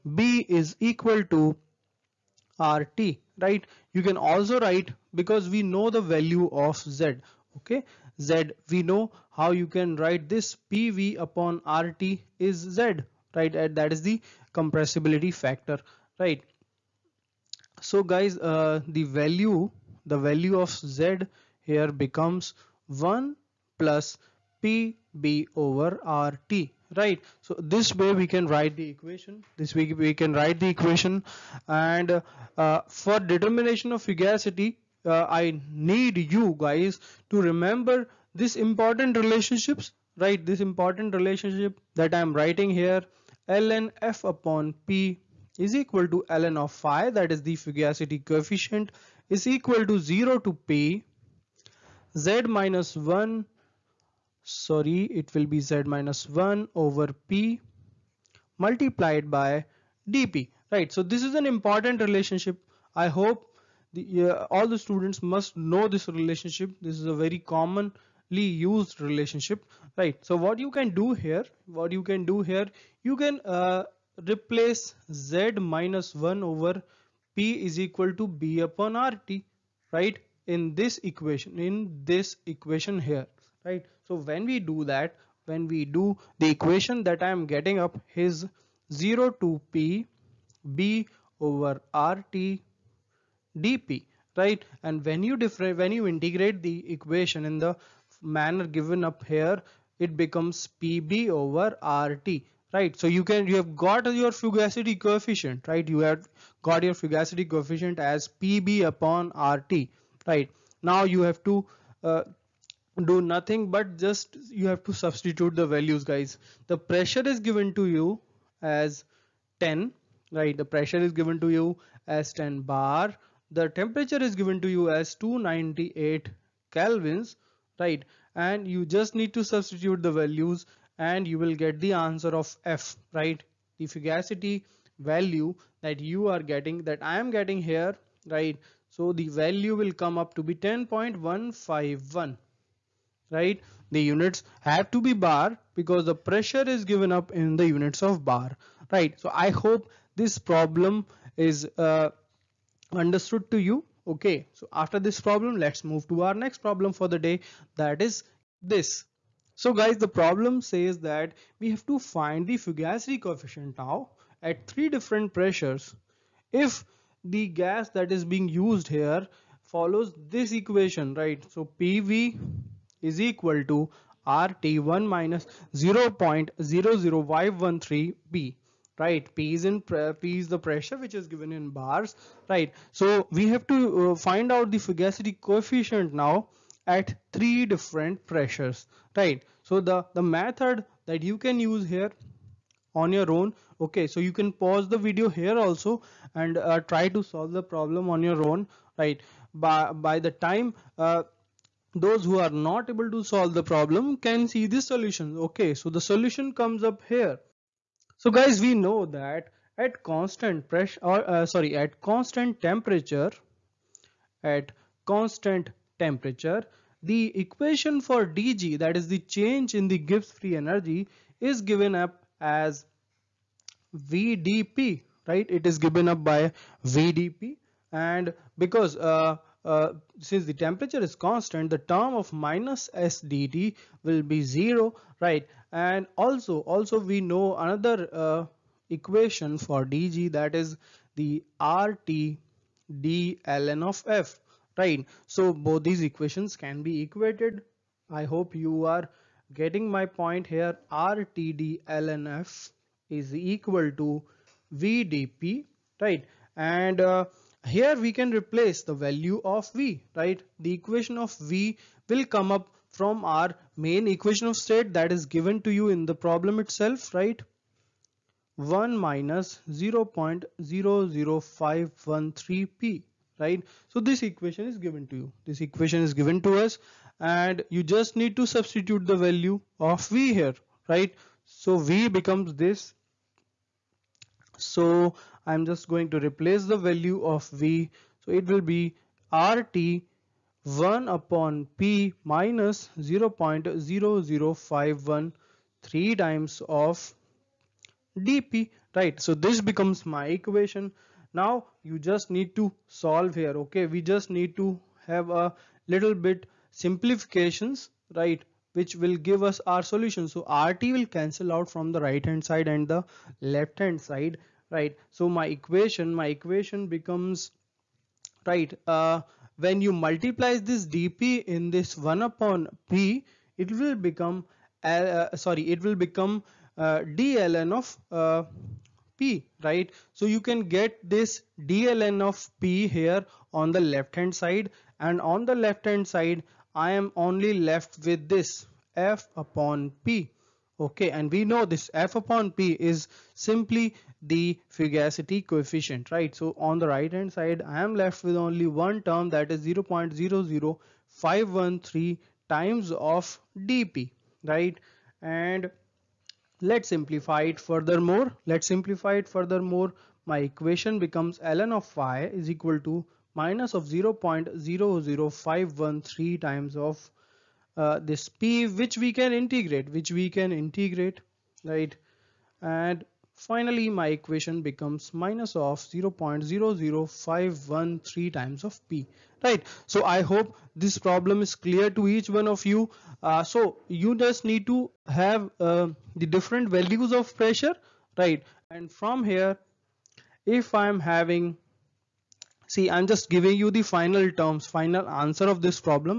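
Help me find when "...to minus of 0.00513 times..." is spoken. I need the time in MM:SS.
06:02.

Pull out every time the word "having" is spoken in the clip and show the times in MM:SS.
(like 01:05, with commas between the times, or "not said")
06:30.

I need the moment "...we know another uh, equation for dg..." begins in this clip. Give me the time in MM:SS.
03:57.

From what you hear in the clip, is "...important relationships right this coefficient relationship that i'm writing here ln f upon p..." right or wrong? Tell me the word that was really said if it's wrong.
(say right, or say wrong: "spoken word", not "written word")
wrong: "important", not "coefficient".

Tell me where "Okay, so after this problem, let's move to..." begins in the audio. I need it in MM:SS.
02:34.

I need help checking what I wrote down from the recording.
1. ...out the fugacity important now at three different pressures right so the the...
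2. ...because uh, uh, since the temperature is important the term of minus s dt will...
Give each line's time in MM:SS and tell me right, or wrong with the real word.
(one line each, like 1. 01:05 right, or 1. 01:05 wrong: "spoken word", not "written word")
1. 03:04 wrong: "coefficient", not "important"
2. 03:48 wrong: "constant", not "important".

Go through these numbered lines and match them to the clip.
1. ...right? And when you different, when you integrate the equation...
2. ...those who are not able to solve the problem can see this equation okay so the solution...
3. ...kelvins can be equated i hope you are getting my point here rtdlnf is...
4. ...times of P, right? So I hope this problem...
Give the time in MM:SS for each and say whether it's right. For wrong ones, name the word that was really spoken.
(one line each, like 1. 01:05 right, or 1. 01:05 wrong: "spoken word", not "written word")
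1. 01:34 right
2. 03:21 wrong: "solution", not "equation"
3. 04:06 wrong: "equations", not "kelvins"
4. 06:18 right.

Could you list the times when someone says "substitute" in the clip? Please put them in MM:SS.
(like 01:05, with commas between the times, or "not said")
01:54, 02:09, 04:38.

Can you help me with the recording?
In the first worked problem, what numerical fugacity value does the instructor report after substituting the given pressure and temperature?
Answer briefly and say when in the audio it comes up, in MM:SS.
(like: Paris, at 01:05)
10.151, at 02:20.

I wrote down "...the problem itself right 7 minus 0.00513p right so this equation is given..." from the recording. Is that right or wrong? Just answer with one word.
wrong.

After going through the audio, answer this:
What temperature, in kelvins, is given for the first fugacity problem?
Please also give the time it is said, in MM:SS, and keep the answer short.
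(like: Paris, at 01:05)
298 kelvins, at 02:05.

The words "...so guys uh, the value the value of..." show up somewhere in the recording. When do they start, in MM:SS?
00:17.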